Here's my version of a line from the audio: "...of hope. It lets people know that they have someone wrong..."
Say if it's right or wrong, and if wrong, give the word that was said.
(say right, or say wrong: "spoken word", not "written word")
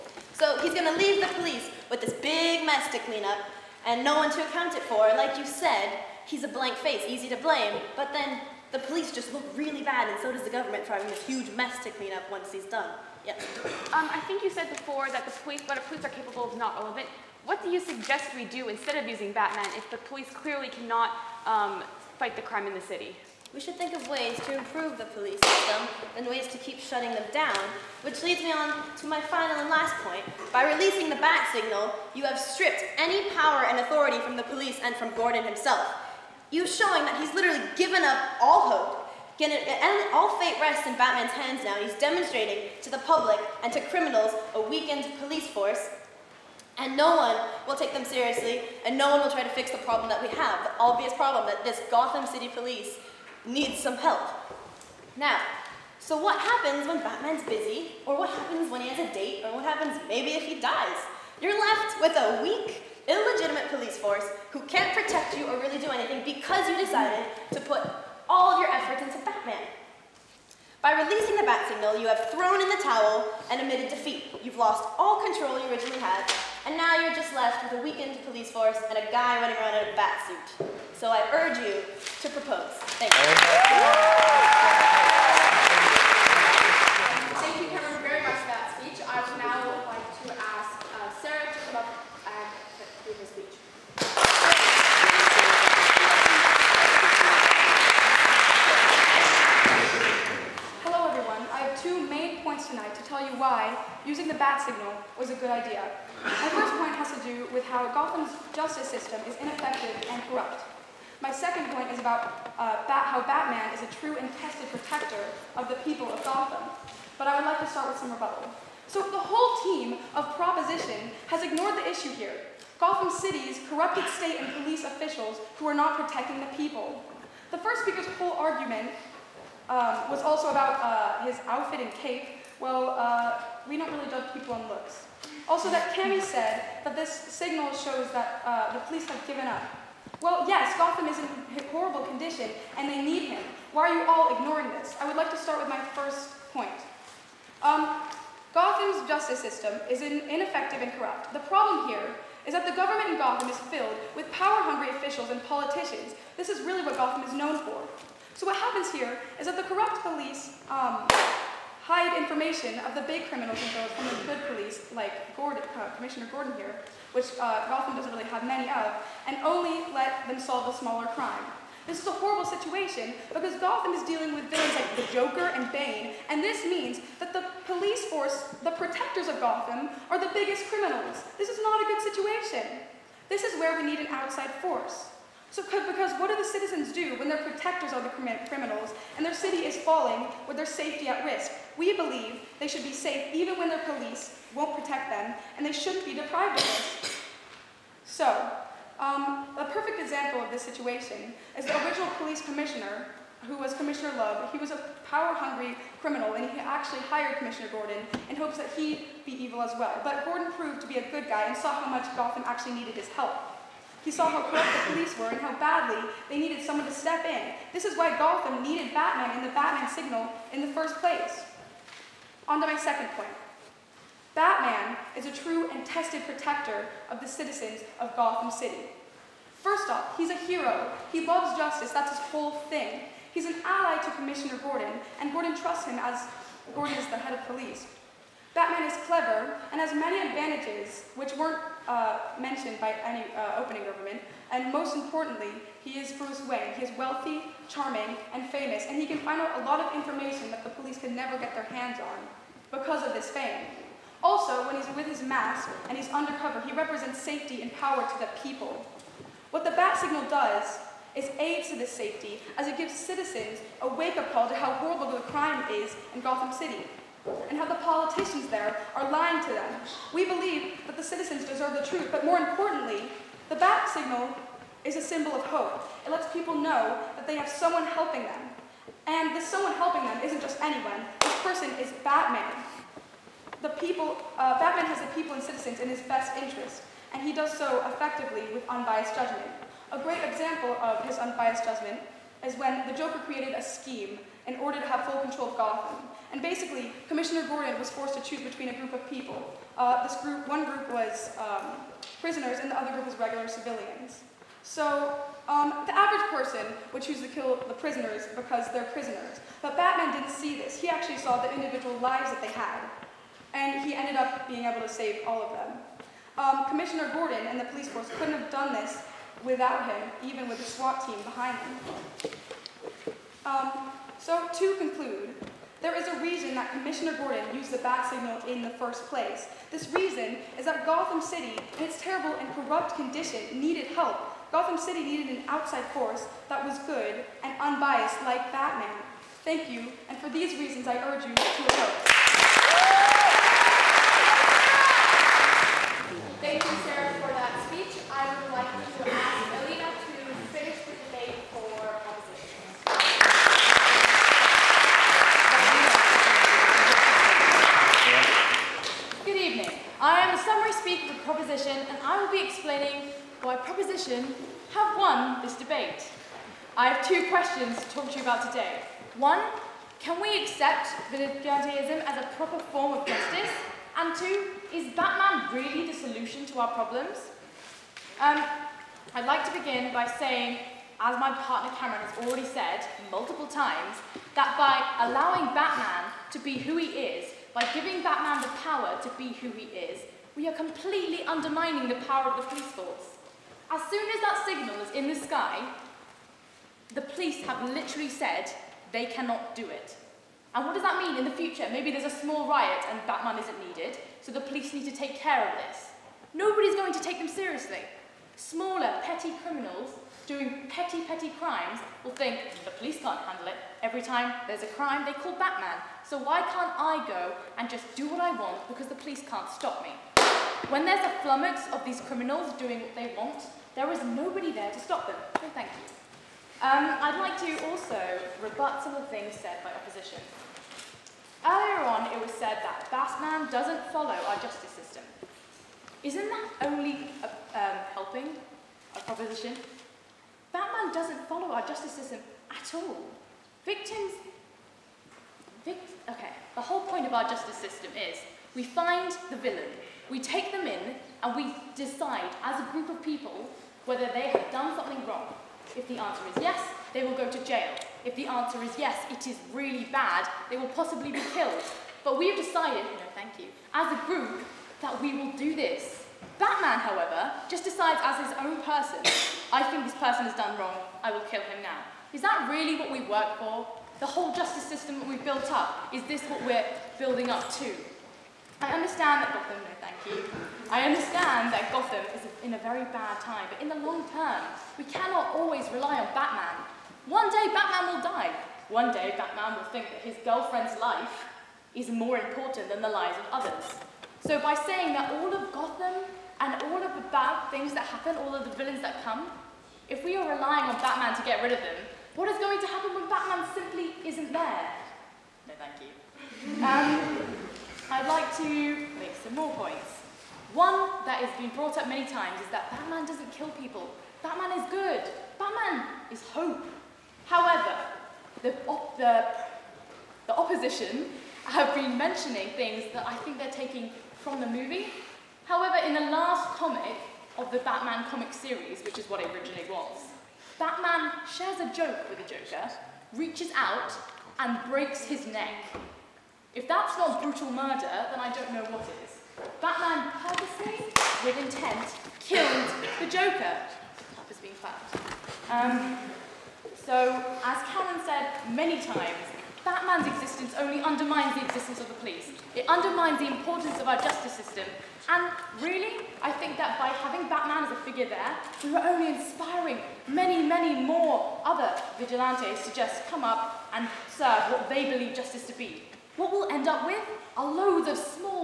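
wrong: "helping", not "wrong".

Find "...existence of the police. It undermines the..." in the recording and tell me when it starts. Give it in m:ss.
9:11.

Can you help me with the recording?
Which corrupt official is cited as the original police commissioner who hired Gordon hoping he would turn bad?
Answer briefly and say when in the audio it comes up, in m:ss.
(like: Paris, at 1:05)
Commissioner Loeb, at 3:23.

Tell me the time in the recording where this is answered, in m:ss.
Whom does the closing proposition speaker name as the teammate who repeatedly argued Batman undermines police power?
6:21.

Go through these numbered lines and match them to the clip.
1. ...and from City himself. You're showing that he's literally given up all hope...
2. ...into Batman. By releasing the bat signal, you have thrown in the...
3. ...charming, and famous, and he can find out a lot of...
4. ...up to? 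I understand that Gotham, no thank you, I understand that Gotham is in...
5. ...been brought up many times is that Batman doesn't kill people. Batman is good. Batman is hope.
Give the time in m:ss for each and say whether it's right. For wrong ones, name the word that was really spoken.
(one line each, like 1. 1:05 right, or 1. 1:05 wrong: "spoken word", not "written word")
1. 0:34 wrong: "Gordon", not "City"
2. 1:09 right
3. 4:07 right
4. 7:57 right
5. 8:31 right.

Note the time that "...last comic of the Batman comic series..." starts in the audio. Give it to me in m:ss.
8:46.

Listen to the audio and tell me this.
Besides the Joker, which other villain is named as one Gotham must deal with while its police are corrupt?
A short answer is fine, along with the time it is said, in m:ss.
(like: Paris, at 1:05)
Bane, at 2:55.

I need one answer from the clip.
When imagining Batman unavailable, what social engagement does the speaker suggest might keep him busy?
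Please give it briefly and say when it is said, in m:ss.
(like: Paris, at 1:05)
A date, at 0:58.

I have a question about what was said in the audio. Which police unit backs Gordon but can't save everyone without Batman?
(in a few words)
SWAT team.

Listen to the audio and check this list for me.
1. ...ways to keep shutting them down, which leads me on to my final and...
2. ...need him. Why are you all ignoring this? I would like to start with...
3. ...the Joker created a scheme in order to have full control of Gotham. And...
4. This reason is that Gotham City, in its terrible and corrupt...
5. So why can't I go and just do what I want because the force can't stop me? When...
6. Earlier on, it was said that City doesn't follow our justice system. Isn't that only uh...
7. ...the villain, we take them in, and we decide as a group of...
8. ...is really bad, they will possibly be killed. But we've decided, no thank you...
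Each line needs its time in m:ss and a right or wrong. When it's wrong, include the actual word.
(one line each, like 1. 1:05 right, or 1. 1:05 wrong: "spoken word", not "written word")
1. 0:26 right
2. 2:23 right
3. 4:52 right
4. 5:29 right
5. 6:56 wrong: "police", not "force"
6. 7:11 wrong: "Batman", not "City"
7. 7:29 right
8. 7:39 right.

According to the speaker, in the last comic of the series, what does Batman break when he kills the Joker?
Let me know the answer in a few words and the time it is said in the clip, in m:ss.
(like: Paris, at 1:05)
His neck, at 8:55.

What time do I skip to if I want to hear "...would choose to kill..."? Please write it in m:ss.
5:06.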